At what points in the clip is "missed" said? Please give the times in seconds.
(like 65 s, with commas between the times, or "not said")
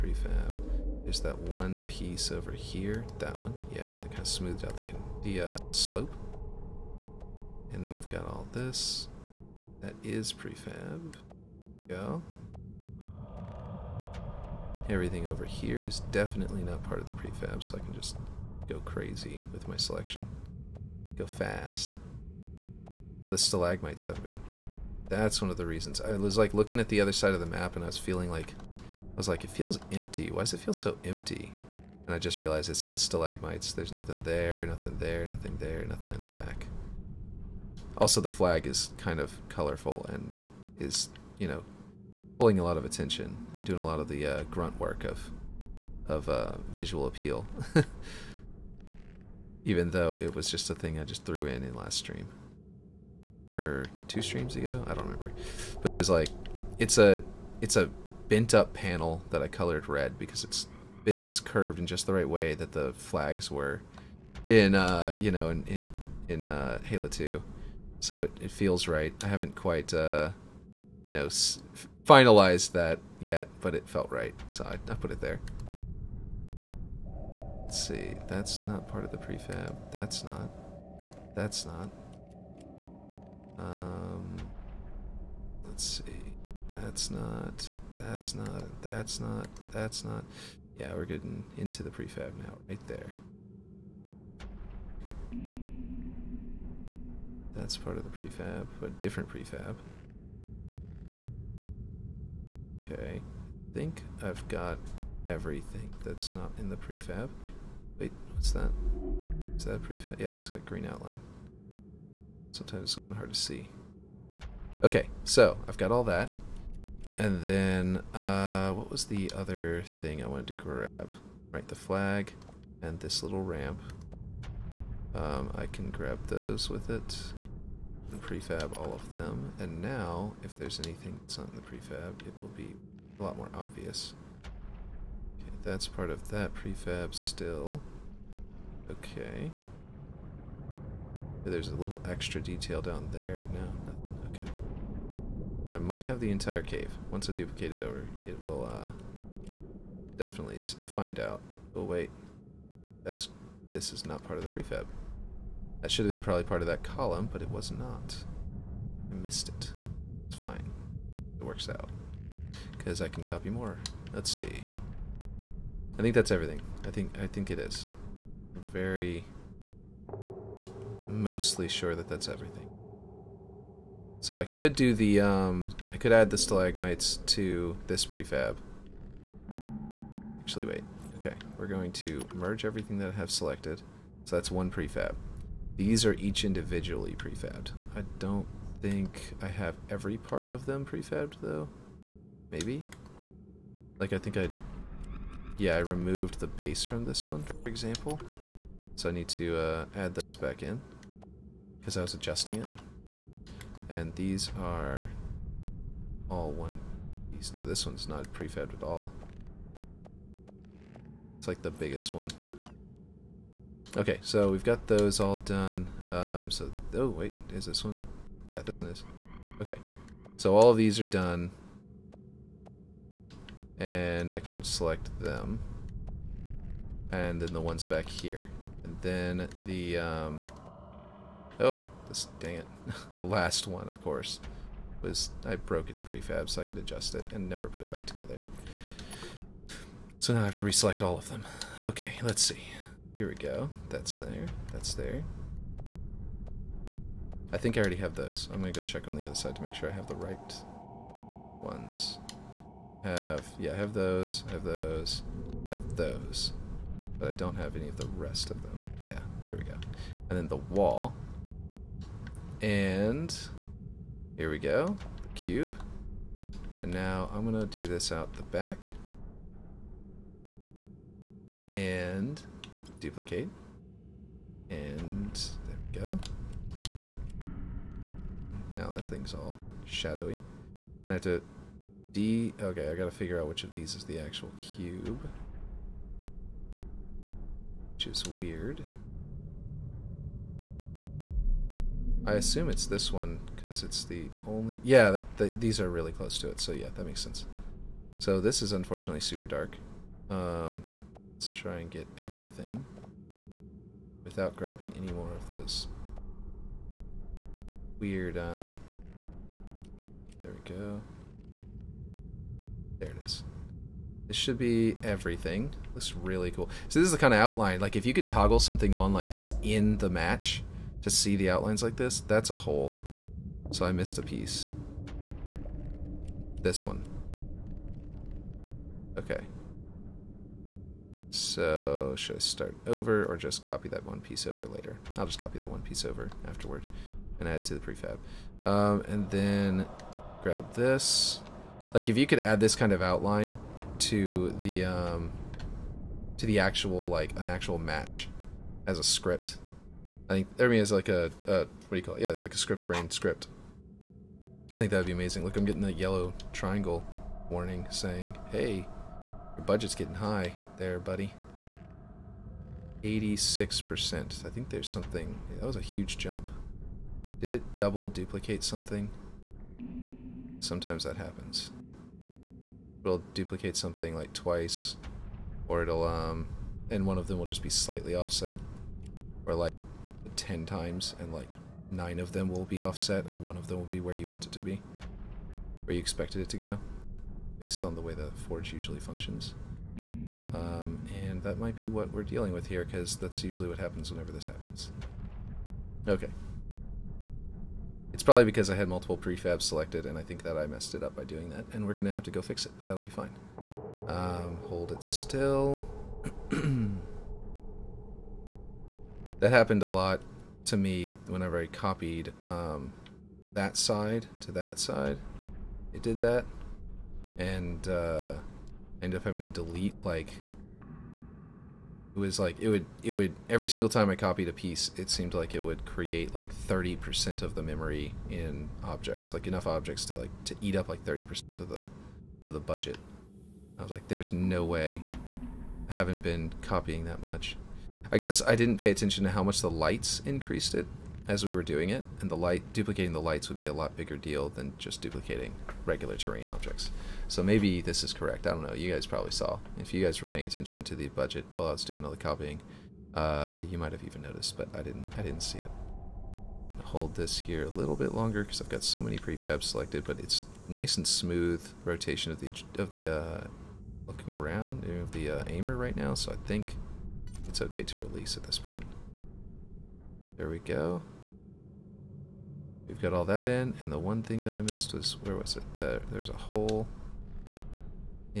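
159 s, 323 s, 474 s.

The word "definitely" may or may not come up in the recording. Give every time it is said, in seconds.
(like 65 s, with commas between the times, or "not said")
16 s, 150 s.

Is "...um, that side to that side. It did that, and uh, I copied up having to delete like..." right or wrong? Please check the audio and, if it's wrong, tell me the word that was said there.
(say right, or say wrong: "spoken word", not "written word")
wrong: "ended", not "copied".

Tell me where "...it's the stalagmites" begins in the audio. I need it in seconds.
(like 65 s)
32 s.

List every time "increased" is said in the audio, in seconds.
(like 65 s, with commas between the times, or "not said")
440 s.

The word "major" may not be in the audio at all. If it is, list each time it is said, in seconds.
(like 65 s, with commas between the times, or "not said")
not said.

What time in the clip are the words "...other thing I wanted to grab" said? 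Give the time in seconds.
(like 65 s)
119 s.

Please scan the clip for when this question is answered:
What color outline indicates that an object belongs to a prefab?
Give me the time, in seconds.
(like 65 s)
110 s.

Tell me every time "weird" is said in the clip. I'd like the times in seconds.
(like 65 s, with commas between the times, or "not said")
288 s, 307 s.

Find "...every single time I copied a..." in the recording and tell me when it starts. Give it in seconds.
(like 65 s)
423 s.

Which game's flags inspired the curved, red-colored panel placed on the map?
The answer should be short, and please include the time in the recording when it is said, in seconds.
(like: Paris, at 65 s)
Halo 2, at 66 s.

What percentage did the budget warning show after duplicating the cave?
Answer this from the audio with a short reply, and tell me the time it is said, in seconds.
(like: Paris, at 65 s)
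86%, at 363 s.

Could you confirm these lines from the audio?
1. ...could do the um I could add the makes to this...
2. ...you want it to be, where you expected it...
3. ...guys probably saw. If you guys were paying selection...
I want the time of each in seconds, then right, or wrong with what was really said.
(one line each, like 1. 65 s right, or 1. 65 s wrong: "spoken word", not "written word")
1. 174 s wrong: "stalagmites", not "makes"
2. 384 s right
3. 448 s wrong: "attention", not "selection".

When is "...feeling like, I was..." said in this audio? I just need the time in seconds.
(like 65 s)
27 s.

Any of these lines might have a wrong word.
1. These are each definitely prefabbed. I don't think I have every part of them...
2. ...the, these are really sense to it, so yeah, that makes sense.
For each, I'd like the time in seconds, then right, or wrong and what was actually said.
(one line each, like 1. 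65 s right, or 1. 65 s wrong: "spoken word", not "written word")
1. 185 s wrong: "individually", not "definitely"
2. 295 s wrong: "close", not "sense".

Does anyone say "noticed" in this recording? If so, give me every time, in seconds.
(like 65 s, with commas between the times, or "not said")
454 s.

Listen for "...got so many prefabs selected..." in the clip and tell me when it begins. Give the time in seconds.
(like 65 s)
458 s.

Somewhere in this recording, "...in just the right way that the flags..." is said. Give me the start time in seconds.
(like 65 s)
61 s.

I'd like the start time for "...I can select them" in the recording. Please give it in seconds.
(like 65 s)
224 s.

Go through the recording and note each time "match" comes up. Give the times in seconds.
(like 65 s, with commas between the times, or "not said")
320 s, 347 s.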